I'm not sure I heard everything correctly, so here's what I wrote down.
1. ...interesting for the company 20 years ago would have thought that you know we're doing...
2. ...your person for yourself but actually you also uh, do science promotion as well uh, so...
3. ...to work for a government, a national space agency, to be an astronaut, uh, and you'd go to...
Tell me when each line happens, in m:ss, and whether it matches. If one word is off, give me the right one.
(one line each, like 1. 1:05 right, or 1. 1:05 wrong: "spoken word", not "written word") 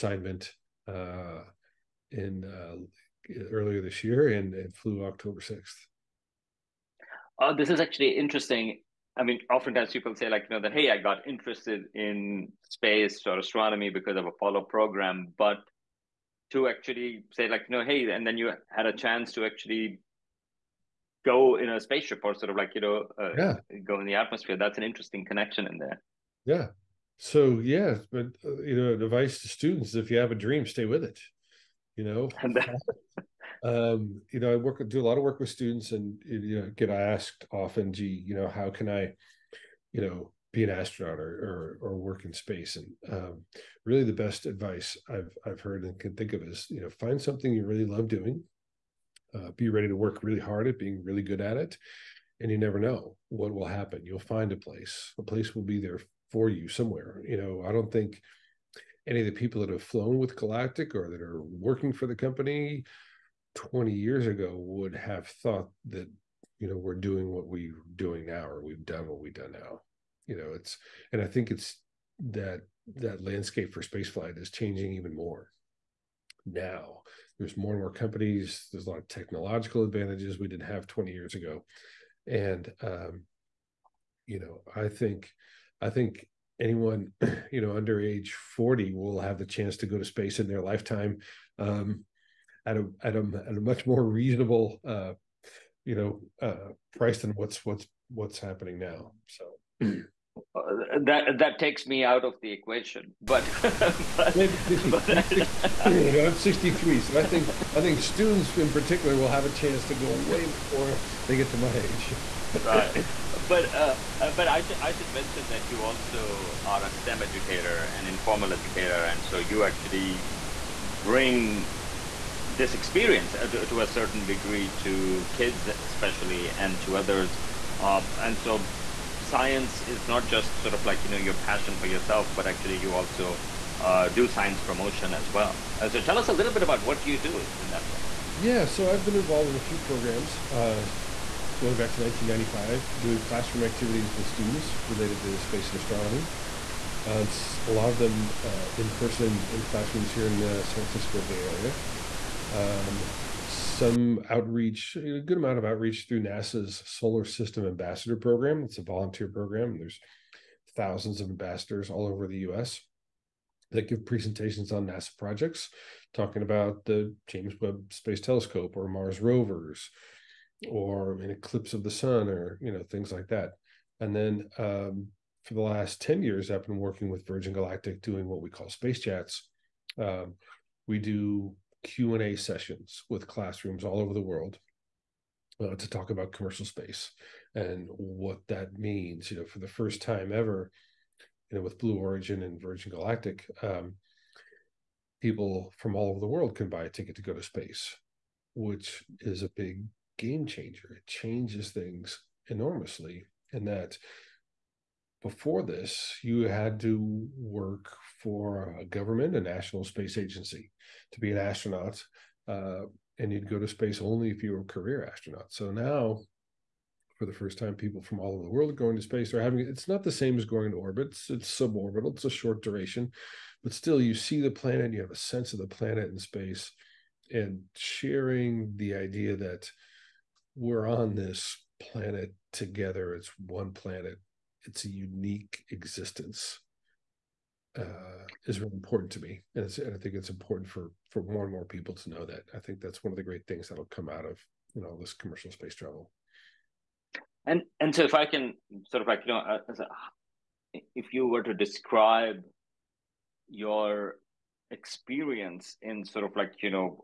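1. 1:01 wrong: "working", not "interesting"
2. 2:11 wrong: "passion", not "person"
3. 3:26 right.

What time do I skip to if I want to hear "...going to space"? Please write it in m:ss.
3:38.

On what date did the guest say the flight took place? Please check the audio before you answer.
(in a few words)
October 6.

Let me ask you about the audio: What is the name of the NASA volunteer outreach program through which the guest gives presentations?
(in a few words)
Solar System Ambassador Program.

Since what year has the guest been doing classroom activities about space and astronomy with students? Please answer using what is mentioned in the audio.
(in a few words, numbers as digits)
1995.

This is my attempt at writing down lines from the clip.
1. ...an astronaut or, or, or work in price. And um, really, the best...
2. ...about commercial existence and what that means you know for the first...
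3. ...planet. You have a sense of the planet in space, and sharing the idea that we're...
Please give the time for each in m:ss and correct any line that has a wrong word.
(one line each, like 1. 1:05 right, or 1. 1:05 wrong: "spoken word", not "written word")
1. 0:40 wrong: "space", not "price"
2. 3:06 wrong: "space", not "existence"
3. 3:44 right.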